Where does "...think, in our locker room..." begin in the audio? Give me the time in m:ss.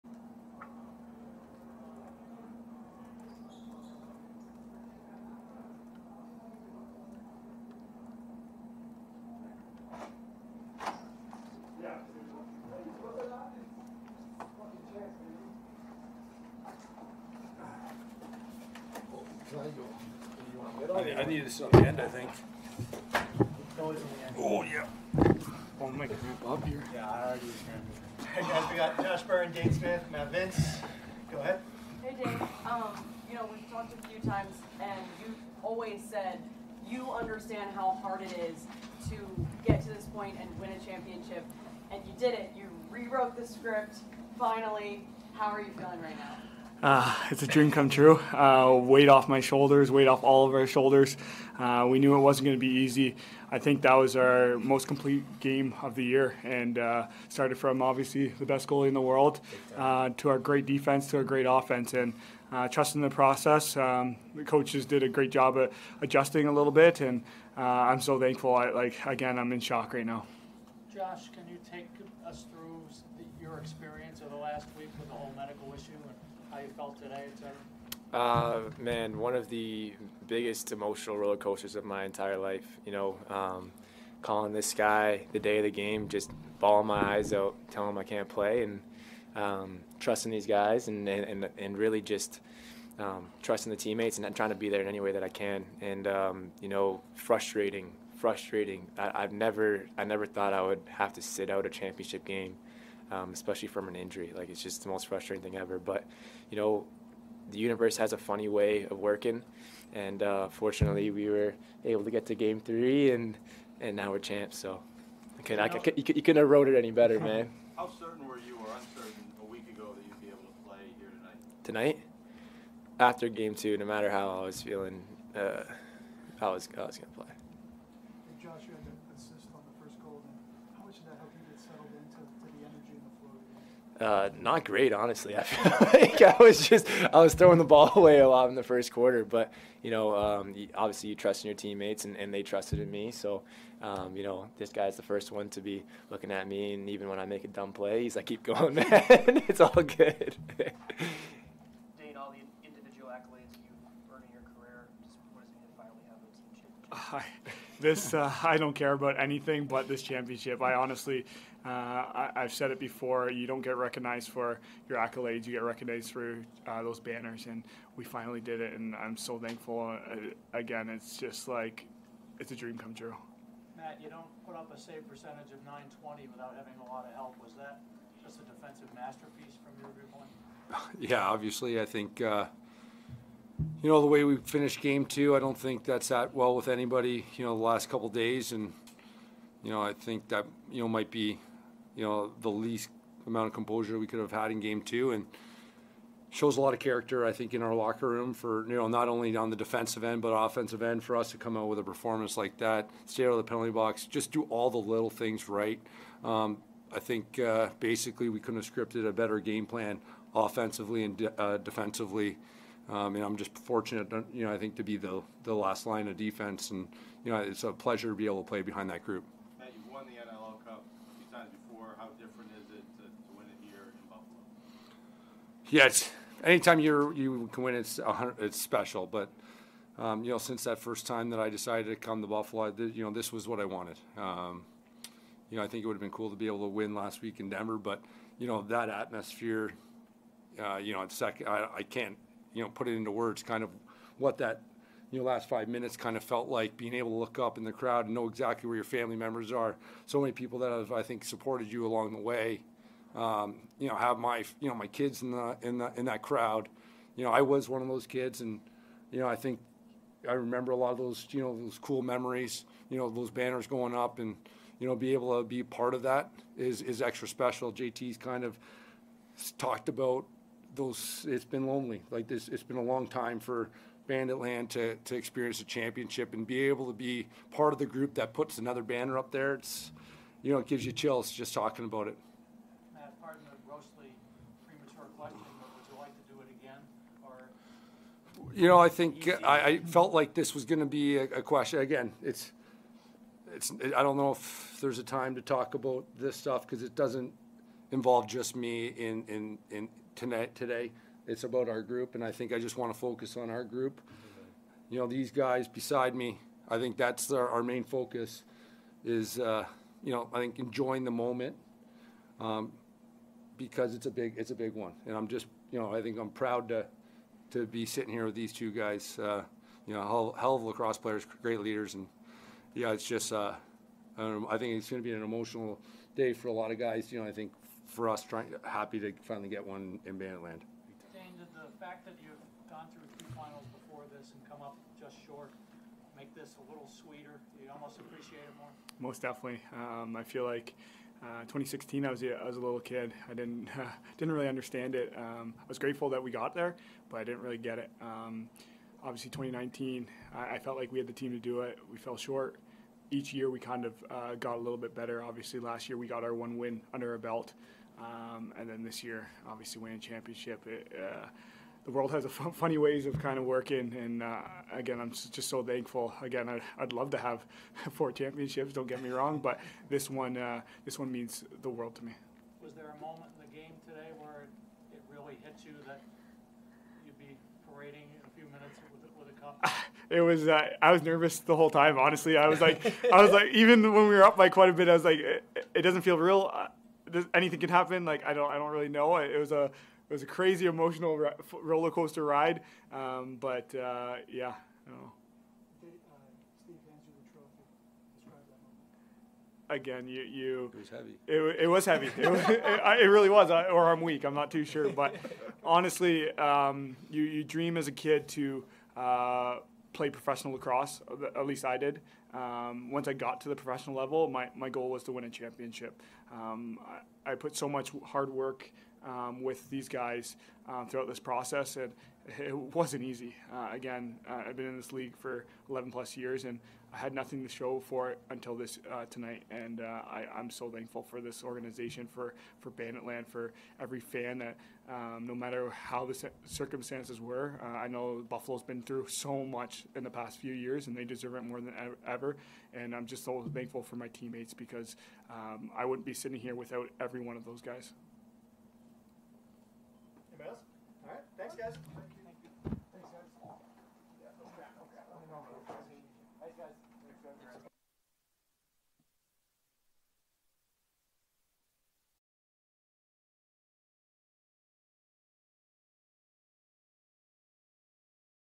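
3:17.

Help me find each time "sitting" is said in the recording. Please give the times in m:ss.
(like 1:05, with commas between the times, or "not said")
5:17, 7:26.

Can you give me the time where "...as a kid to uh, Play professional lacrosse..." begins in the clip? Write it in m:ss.
6:47.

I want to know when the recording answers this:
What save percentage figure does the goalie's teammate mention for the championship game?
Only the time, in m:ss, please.
2:55.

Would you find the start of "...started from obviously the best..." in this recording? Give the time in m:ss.
0:57.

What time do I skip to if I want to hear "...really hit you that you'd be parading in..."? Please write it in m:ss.
6:15.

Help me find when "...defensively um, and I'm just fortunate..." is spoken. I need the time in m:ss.
3:31.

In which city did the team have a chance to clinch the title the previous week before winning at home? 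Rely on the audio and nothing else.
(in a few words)
Denver.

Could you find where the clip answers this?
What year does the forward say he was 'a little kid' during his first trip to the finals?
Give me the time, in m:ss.
5:41.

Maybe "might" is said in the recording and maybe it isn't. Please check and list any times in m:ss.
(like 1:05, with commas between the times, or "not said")
3:10.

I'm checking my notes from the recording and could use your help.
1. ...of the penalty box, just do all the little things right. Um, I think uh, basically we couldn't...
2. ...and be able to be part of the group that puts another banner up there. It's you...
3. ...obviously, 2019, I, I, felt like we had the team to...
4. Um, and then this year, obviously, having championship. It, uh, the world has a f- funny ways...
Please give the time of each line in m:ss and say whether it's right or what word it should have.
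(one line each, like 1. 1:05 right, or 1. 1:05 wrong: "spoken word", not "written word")
1. 3:23 right
2. 4:36 right
3. 5:49 right
4. 5:58 wrong: "winning", not "having".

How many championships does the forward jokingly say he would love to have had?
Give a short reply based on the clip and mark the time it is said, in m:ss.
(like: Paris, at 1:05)
4, at 6:07.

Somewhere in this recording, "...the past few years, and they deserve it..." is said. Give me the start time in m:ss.
7:20.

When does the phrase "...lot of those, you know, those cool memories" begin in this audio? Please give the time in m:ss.
4:20.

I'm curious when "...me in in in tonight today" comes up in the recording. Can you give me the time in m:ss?
4:58.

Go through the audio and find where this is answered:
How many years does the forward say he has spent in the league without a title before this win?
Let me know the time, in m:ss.
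7:05.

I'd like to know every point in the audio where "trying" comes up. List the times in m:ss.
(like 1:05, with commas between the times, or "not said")
1:34, 5:28.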